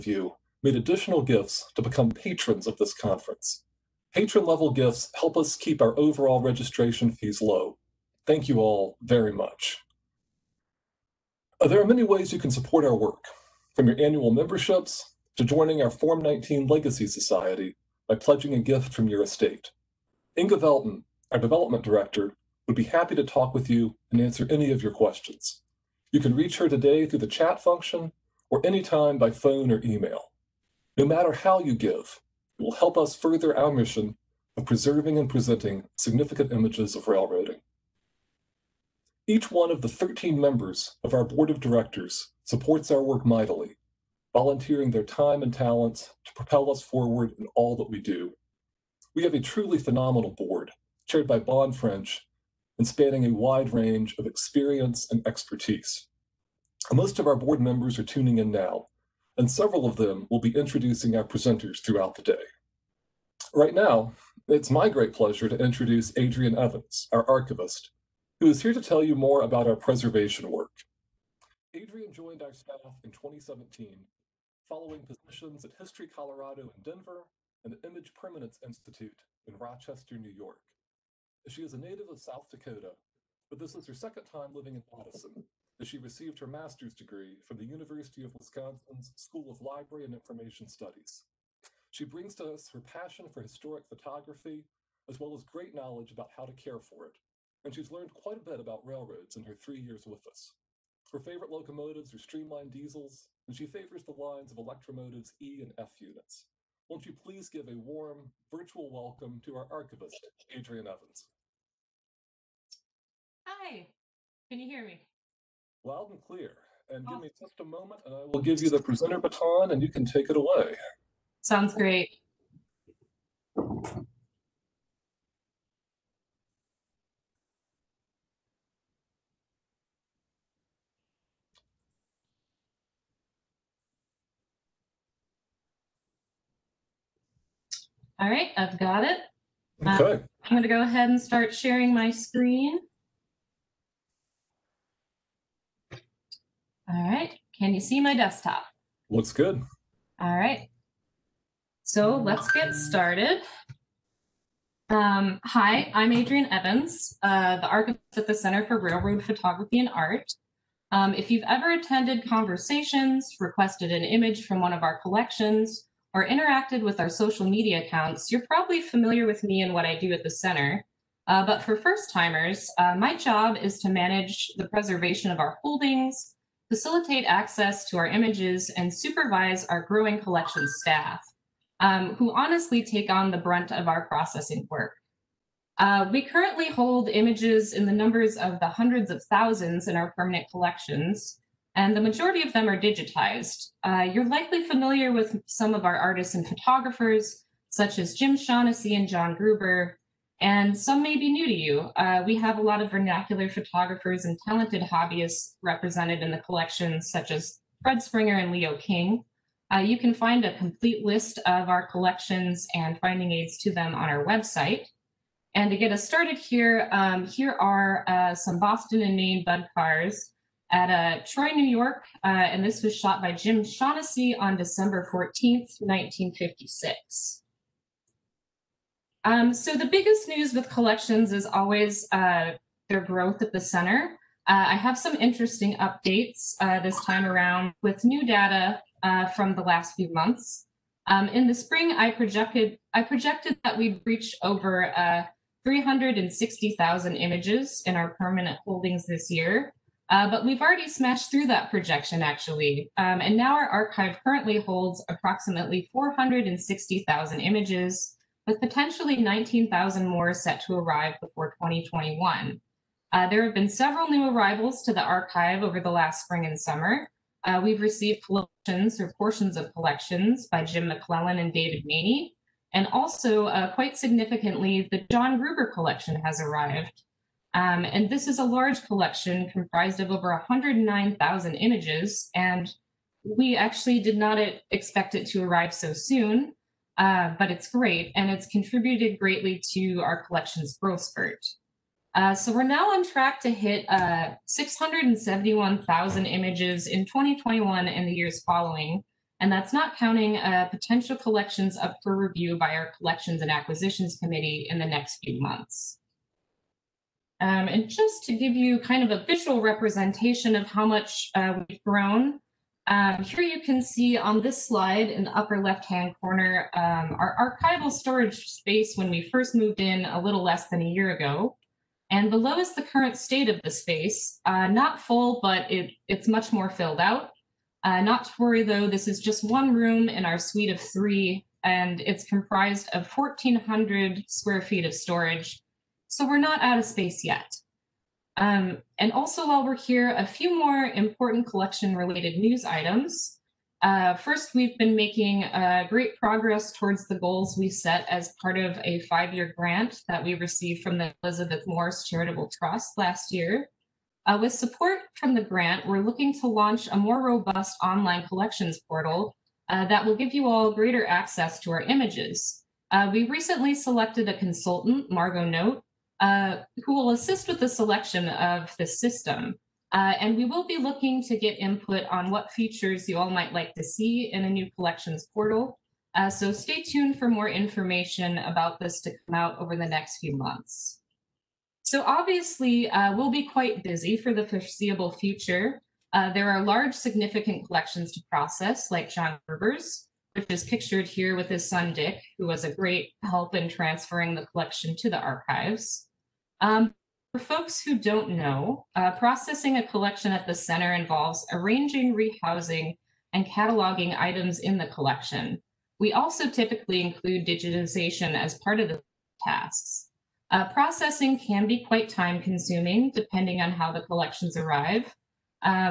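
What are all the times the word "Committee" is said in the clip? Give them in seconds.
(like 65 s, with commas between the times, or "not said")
304 s.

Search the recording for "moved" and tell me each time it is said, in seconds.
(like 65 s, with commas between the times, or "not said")
319 s.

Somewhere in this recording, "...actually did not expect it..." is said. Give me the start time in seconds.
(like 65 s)
283 s.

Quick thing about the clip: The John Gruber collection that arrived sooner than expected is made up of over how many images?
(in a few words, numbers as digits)
109,000.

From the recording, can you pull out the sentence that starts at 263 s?
Uh, there have been several new arrivals to the archive over the last spring and summer.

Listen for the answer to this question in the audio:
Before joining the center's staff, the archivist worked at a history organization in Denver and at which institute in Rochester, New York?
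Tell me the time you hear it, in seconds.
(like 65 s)
77 s.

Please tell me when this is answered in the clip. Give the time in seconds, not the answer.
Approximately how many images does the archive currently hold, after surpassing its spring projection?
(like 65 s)
255 s.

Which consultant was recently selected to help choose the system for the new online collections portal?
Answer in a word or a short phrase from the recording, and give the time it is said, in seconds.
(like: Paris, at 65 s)
Margot Note, at 365 s.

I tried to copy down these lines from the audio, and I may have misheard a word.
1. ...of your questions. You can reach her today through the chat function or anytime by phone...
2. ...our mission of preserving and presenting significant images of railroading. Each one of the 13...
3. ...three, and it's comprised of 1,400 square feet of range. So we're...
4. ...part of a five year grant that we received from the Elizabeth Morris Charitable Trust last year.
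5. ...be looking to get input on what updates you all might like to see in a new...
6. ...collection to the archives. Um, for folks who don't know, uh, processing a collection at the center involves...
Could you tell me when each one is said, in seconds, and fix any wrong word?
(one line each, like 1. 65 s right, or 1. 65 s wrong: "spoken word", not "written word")
1. 24 s right
2. 33 s right
3. 330 s wrong: "storage", not "range"
4. 348 s right
5. 370 s wrong: "features", not "updates"
6. 394 s right.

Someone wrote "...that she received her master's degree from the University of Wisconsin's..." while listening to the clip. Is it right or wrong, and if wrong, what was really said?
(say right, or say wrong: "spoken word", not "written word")
right.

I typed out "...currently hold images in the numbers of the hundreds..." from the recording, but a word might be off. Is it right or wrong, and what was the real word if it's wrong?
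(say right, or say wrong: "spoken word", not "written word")
right.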